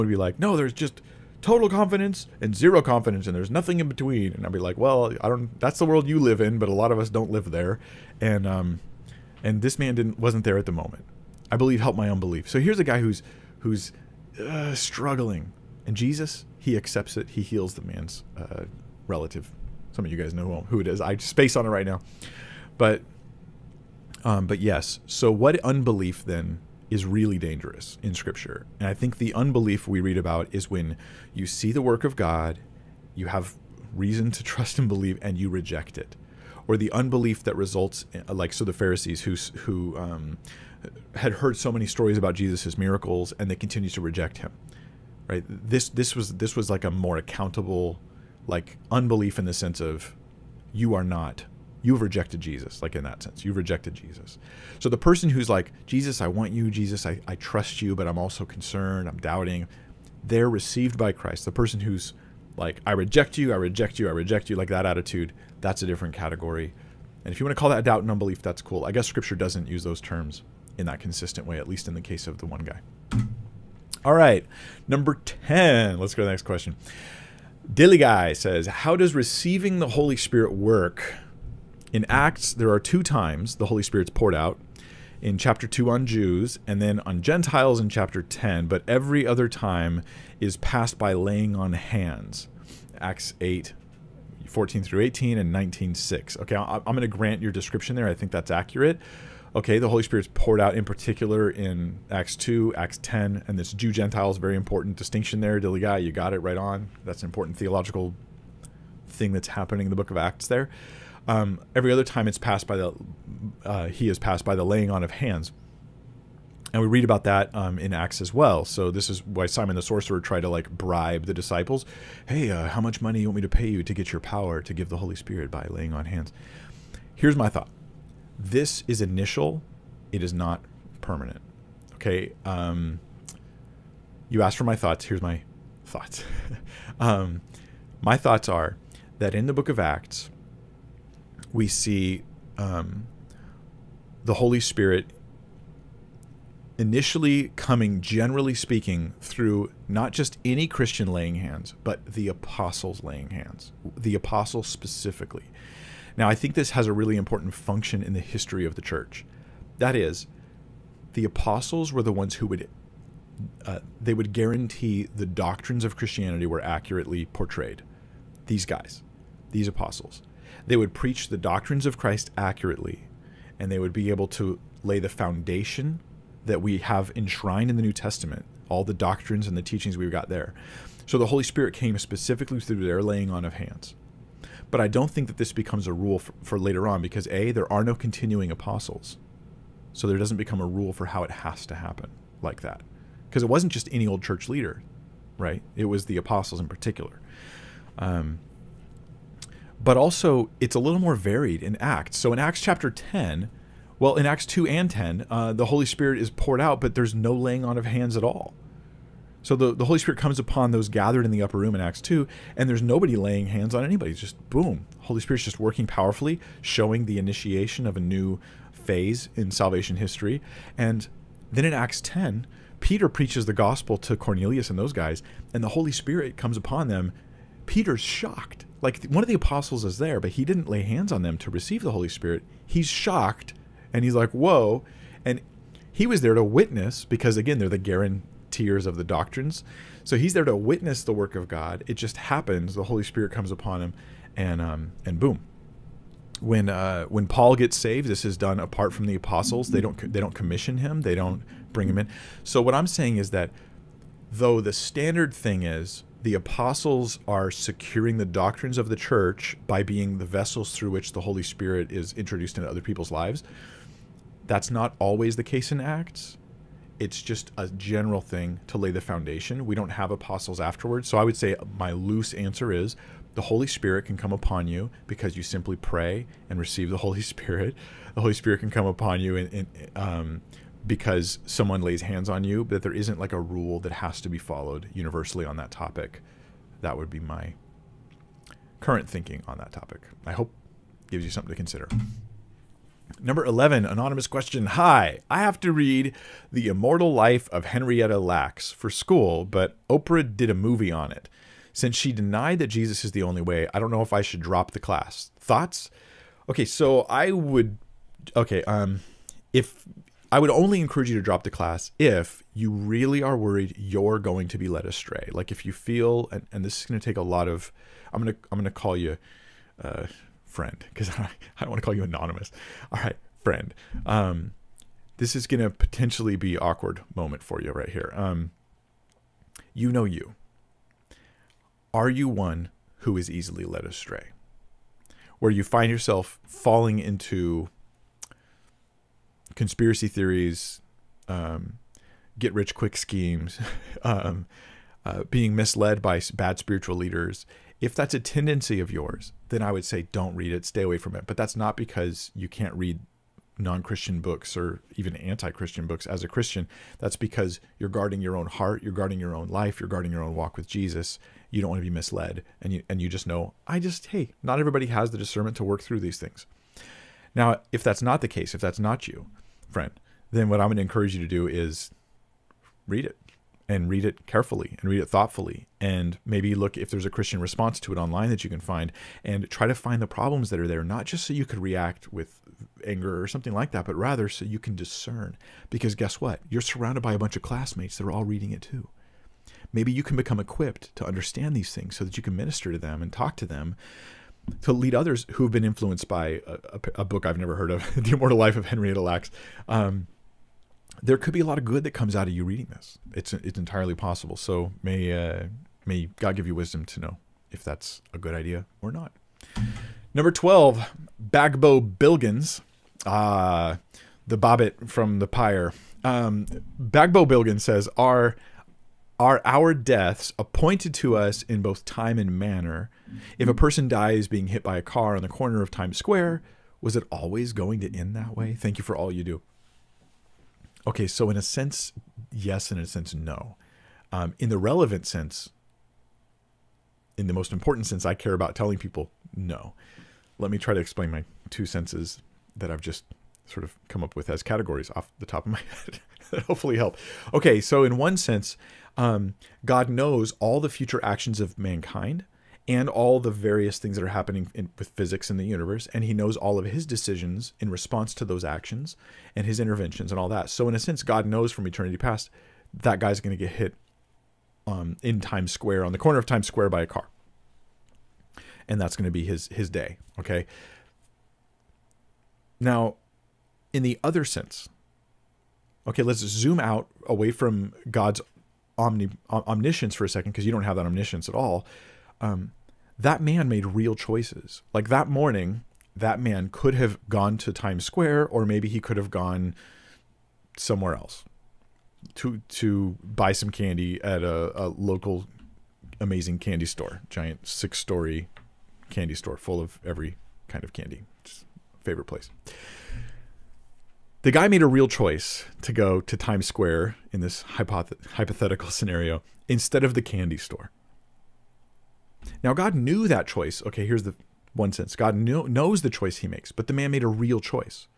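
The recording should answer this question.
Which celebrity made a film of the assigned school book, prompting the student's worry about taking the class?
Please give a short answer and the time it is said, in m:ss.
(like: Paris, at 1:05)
Oprah, at 4:59.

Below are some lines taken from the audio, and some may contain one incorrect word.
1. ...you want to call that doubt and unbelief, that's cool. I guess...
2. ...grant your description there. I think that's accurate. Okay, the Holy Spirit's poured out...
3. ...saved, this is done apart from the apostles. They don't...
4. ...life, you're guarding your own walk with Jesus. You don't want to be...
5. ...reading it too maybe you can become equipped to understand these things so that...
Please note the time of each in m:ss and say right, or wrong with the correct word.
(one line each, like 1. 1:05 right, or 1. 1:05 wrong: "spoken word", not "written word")
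1. 1:07 right
2. 1:37 right
3. 4:07 right
4. 5:59 right
5. 6:28 right.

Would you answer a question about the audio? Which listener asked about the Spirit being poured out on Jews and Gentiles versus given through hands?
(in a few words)
Dilly Guy.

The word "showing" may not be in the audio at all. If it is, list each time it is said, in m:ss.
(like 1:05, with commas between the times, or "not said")
3:36.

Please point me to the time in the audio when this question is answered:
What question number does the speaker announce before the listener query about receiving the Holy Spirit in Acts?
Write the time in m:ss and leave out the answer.
1:14.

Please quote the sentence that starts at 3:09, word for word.
So there doesn't become a rule for how it has to happen like that.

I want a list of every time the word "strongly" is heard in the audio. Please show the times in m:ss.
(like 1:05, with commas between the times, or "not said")
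not said.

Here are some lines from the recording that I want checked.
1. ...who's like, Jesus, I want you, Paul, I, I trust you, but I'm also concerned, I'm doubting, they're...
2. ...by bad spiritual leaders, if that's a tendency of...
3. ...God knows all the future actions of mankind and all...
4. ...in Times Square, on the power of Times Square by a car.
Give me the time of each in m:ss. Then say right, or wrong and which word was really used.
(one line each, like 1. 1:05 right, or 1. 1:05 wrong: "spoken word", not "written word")
1. 0:55 wrong: "Jesus", not "Paul"
2. 5:46 right
3. 7:29 right
4. 7:45 wrong: "corner", not "power".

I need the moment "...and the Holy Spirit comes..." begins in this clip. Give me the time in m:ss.
3:45.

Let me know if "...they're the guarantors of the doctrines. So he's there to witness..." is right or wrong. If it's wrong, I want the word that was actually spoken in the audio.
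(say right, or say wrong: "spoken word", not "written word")
right.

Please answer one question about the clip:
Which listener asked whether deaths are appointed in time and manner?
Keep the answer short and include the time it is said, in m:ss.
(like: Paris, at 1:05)
Bagbo Bilgins, at 6:51.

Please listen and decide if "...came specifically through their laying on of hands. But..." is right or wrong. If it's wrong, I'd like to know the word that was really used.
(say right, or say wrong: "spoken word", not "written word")
right.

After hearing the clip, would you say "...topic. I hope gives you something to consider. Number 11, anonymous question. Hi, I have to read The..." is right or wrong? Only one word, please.
right.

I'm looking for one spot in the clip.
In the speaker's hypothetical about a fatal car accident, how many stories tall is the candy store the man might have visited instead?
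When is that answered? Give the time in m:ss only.
8:17.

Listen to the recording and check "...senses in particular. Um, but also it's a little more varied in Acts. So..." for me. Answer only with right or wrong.
wrong.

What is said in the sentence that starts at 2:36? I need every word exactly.
Now, I think this has a really important function in the history of the church.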